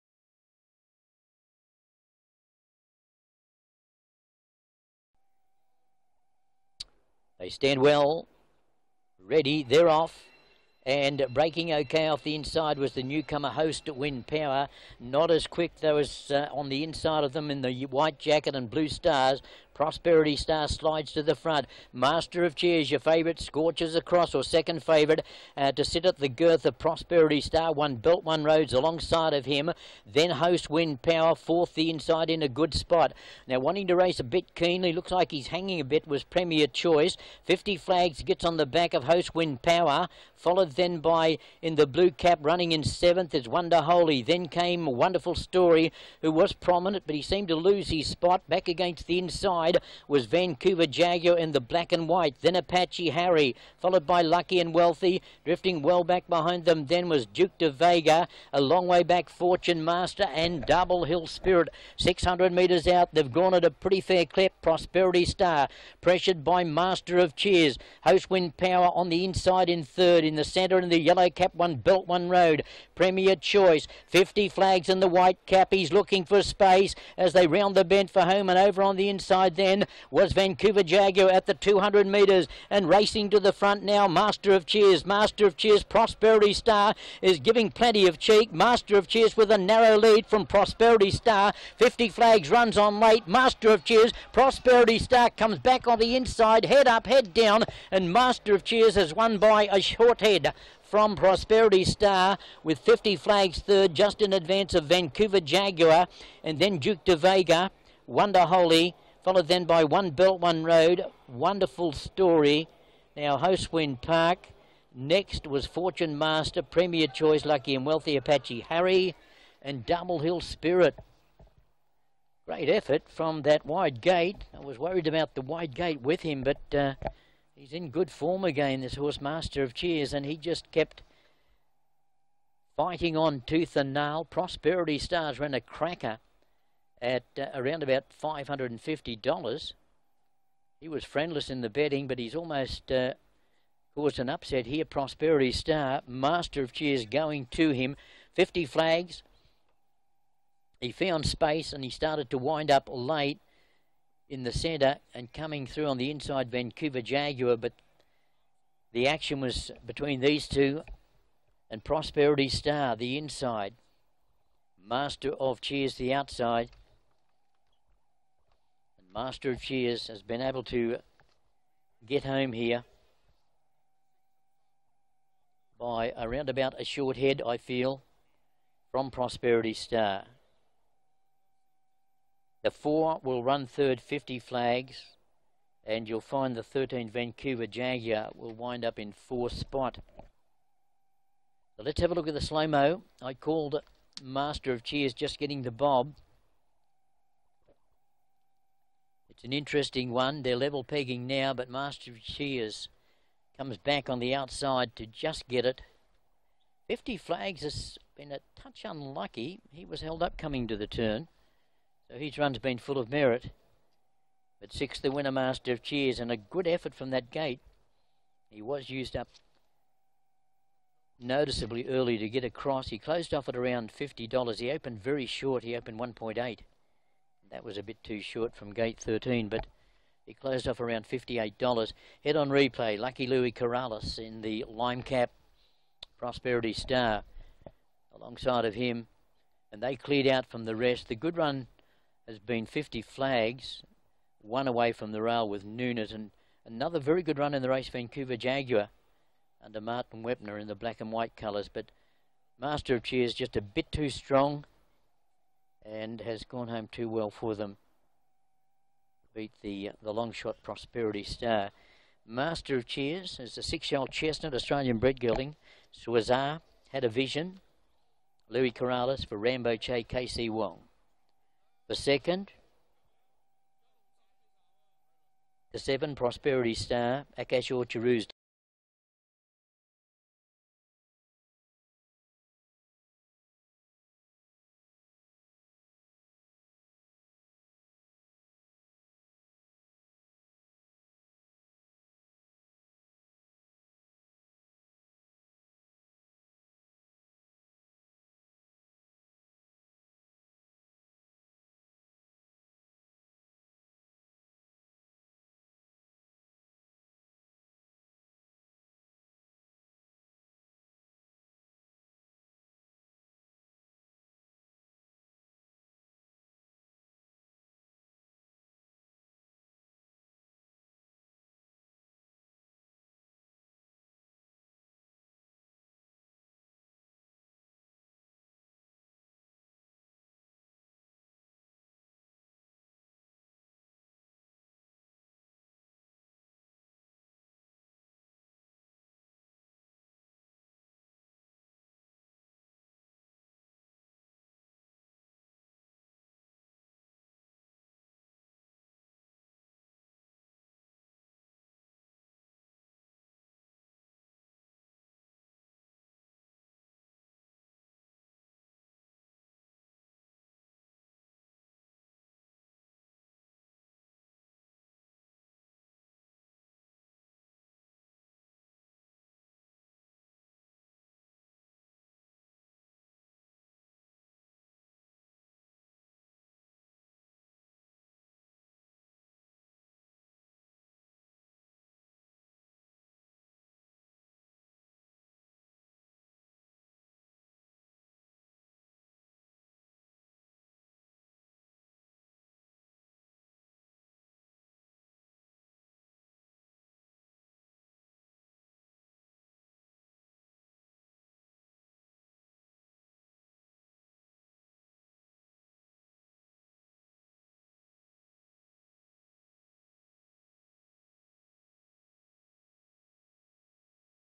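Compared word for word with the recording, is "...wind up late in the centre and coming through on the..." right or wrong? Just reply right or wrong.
right.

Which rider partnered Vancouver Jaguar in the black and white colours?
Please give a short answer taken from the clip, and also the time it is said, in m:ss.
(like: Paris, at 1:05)
Martin Webner, at 4:09.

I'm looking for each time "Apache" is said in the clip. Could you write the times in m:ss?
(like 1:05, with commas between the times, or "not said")
0:52, 1:58.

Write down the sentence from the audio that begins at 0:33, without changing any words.
Now, wanting to race a bit keenly, looks like he's hanging a bit, was Premier Choice.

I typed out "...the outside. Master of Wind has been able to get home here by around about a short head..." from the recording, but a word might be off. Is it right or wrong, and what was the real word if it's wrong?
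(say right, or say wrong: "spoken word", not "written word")
wrong: "Cheers", not "Wind".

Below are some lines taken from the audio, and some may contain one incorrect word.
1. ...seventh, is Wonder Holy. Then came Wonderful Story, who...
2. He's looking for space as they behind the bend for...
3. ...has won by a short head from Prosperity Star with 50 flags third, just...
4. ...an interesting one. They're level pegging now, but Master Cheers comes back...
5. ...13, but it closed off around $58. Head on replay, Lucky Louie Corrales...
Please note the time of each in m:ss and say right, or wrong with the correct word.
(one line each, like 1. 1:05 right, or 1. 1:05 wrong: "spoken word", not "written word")
1. 0:42 right
2. 1:15 wrong: "round", not "behind"
3. 1:38 right
4. 3:19 right
5. 3:48 right.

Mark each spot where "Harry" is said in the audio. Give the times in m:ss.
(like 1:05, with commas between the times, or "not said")
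0:53, 1:58.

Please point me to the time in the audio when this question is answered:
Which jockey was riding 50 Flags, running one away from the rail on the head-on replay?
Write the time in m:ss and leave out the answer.
4:05.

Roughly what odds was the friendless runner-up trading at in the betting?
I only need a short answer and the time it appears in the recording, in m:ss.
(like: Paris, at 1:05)
$550, at 2:18.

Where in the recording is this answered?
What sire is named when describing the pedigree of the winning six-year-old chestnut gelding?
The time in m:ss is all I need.
4:25.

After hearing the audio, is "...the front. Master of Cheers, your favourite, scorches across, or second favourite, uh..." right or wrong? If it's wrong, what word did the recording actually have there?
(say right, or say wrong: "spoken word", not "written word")
right.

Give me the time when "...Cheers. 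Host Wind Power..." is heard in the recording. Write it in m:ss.
1:07.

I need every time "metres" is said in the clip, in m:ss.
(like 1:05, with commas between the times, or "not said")
1:02, 1:22.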